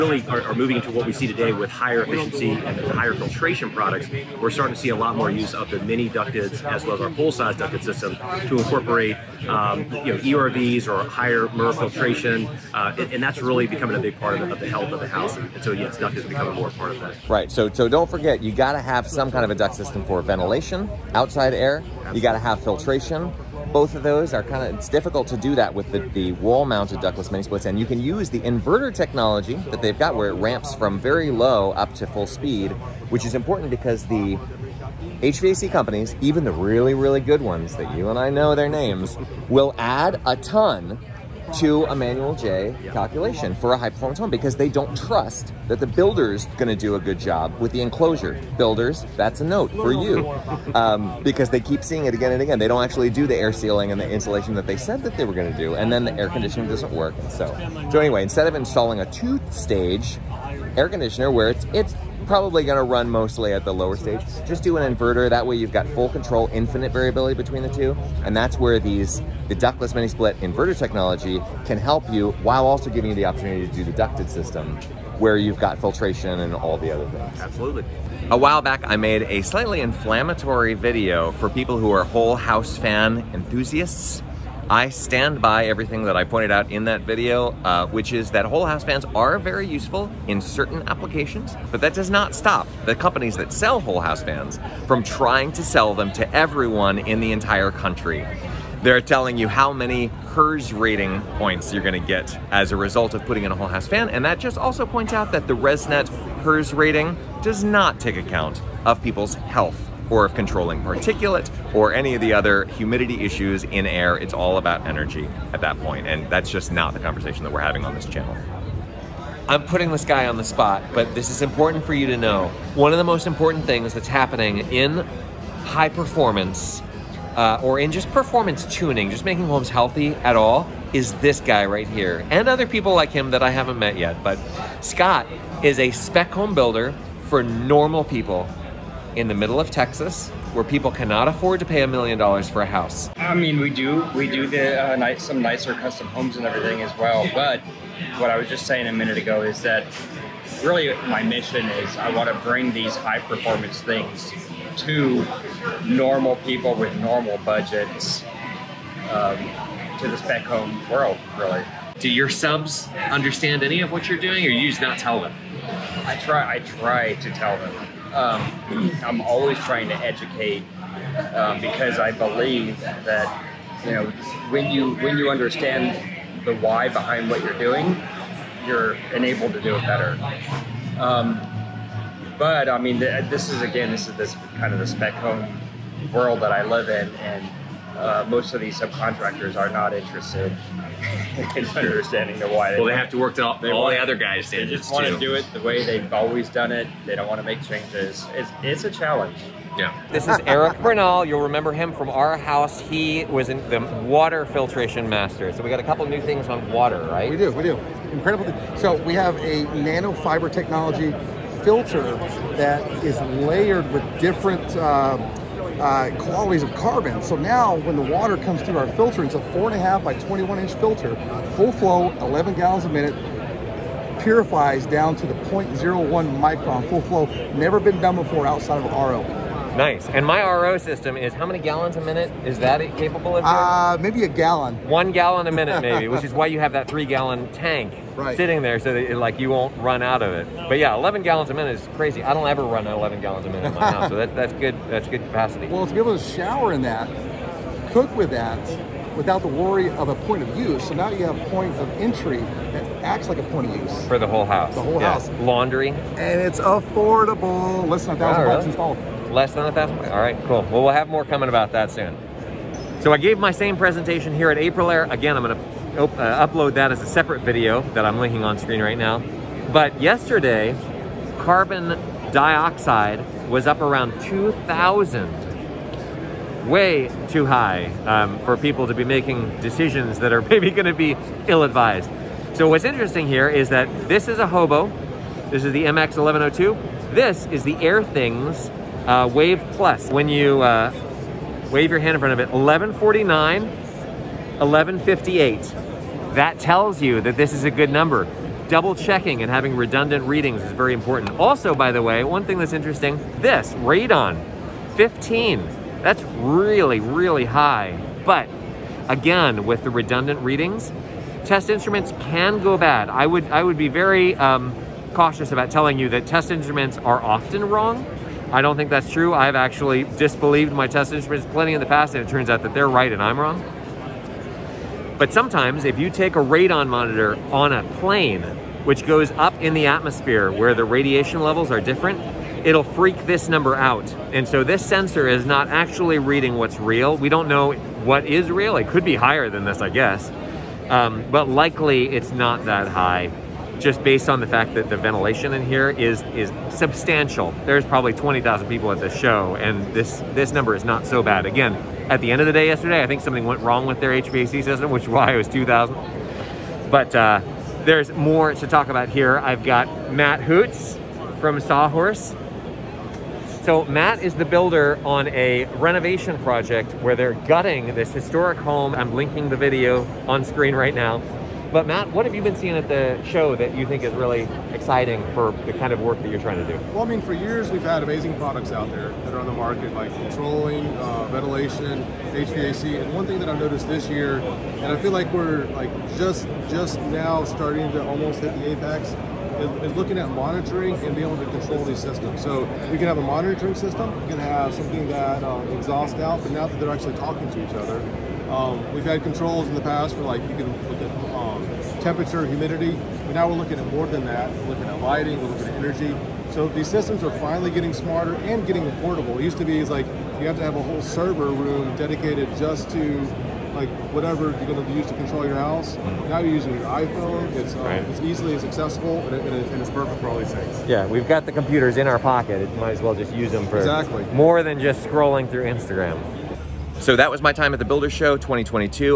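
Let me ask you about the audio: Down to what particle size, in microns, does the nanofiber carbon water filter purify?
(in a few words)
0.01 micron.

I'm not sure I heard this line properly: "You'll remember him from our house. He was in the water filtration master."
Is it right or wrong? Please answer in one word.
right.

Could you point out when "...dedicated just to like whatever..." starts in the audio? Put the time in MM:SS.
06:51.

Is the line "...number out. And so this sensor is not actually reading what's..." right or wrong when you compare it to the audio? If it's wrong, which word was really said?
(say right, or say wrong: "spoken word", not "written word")
right.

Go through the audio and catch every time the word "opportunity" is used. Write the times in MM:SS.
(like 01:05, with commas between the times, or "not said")
01:13.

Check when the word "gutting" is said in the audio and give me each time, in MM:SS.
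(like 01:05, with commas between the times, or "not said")
06:07.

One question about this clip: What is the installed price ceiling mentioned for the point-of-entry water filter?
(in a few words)
Less than a thousand bucks.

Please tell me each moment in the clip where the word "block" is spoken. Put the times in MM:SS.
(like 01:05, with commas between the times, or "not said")
not said.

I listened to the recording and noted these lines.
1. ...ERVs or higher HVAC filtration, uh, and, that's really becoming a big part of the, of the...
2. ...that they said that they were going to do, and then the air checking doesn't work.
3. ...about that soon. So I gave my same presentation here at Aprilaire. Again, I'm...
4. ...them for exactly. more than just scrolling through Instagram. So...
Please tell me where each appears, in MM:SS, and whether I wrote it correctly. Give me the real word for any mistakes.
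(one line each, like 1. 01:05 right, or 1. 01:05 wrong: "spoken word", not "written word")
1. 00:10 wrong: "MERV", not "HVAC"
2. 00:54 wrong: "conditioning", not "checking"
3. 04:21 right
4. 07:03 right.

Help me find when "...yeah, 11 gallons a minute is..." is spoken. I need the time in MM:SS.
04:00.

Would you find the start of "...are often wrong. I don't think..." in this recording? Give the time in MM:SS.
05:16.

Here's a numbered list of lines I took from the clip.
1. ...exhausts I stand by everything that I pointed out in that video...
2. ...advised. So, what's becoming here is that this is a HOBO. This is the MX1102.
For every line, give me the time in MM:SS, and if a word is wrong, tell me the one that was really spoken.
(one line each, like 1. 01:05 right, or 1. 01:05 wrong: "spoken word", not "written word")
1. 01:23 wrong: "enthusiasts", not "exhausts"
2. 04:41 wrong: "interesting", not "becoming".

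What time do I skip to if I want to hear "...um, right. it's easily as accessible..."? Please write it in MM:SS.
06:57.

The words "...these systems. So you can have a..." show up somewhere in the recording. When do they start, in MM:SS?
06:31.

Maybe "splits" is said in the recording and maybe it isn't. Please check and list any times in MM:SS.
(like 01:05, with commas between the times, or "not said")
00:27, 01:10.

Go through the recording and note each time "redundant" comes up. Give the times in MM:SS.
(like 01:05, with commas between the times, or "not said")
04:59, 05:09.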